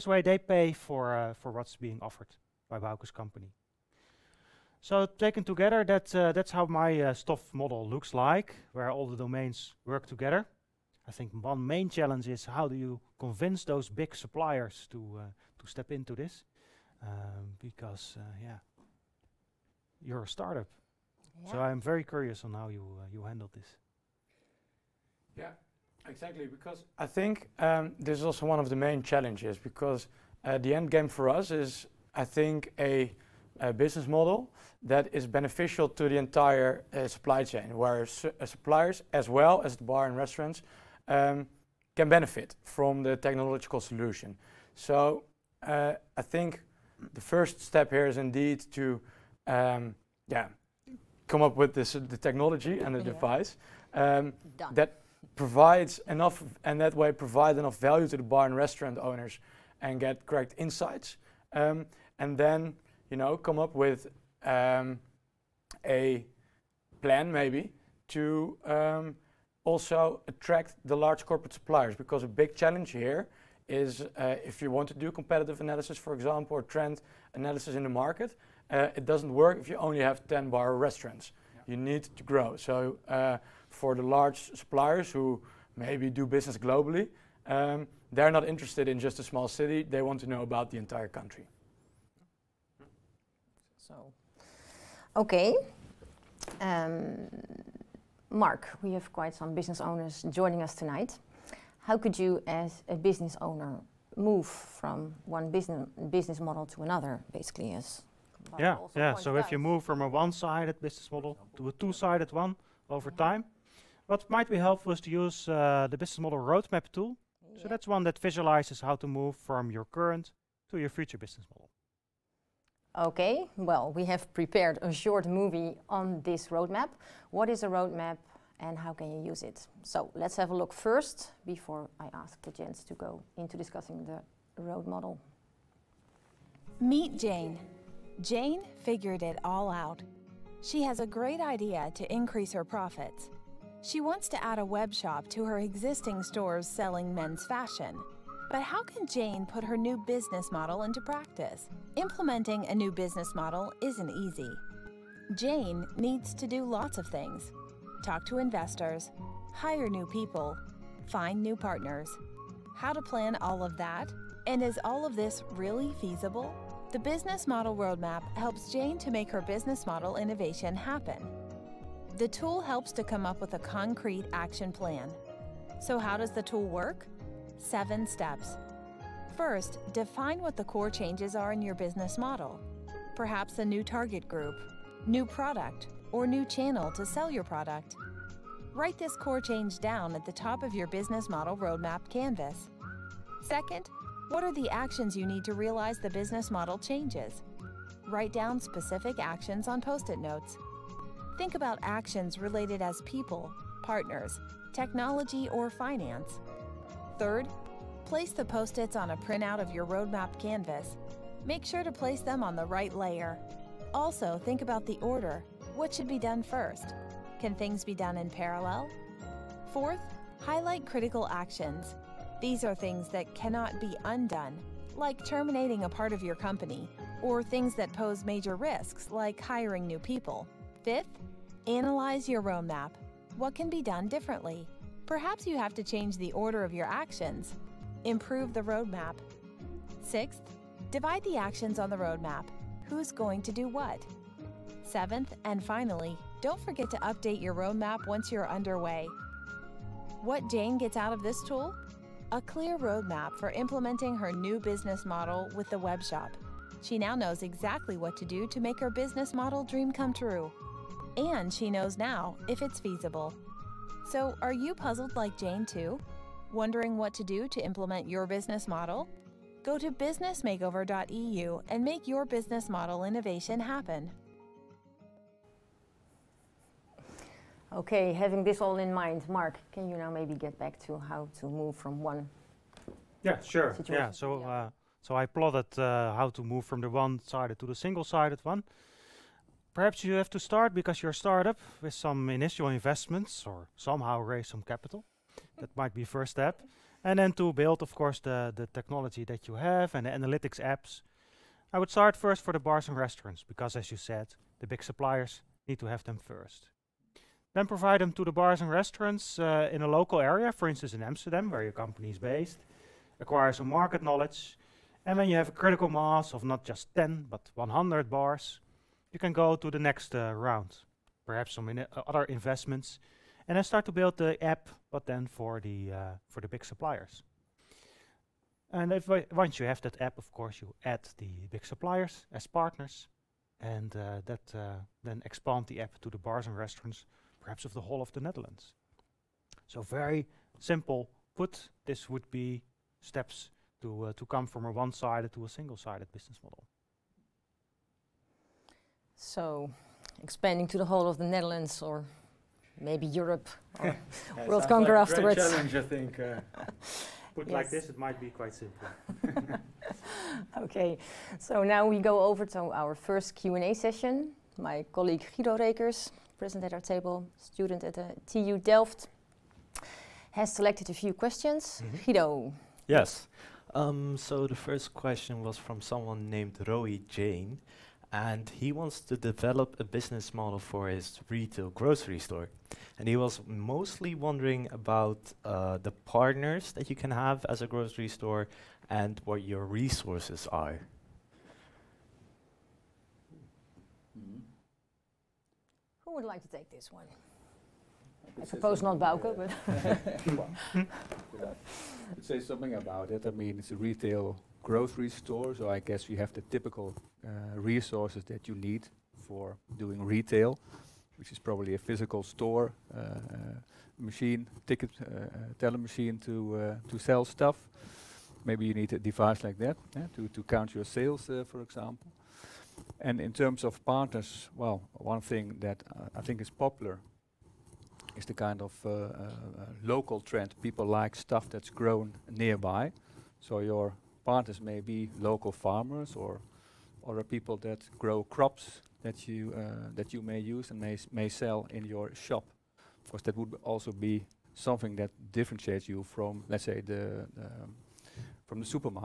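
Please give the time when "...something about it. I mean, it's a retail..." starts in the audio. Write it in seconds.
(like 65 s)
402 s.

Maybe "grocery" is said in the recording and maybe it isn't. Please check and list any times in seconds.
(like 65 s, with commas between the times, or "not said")
381 s, 387 s, 404 s.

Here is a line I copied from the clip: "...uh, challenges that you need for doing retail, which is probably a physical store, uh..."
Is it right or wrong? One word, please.
wrong.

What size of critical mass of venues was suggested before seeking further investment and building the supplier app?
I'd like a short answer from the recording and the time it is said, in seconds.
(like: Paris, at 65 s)
100 bars, at 317 s.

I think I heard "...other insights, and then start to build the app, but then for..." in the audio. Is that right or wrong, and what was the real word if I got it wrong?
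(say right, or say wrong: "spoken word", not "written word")
wrong: "investments", not "insights".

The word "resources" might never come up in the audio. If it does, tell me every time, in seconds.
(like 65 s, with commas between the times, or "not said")
389 s, 407 s.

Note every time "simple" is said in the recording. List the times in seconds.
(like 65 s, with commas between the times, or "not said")
340 s, 358 s.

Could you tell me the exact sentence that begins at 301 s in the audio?
I would start first for the bars and restaurants because, as you said, the big suppliers need to have them first.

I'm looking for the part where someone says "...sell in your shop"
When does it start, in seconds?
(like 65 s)
441 s.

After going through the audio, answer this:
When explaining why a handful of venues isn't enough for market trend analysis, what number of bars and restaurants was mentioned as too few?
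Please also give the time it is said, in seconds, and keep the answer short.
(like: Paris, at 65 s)
10, at 80 s.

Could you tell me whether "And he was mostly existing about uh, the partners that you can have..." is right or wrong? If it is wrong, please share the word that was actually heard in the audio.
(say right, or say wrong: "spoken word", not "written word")
wrong: "wondering", not "existing".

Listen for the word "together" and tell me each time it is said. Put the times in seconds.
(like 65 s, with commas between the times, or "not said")
5 s, 10 s.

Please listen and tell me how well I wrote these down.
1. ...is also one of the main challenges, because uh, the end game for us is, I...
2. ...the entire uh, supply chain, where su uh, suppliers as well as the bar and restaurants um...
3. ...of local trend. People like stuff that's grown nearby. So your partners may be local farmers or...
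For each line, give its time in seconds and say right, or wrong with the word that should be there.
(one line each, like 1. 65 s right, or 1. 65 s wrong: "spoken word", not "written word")
1. 28 s right
2. 36 s right
3. 428 s right.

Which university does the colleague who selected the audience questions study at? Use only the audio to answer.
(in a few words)
TU Delft.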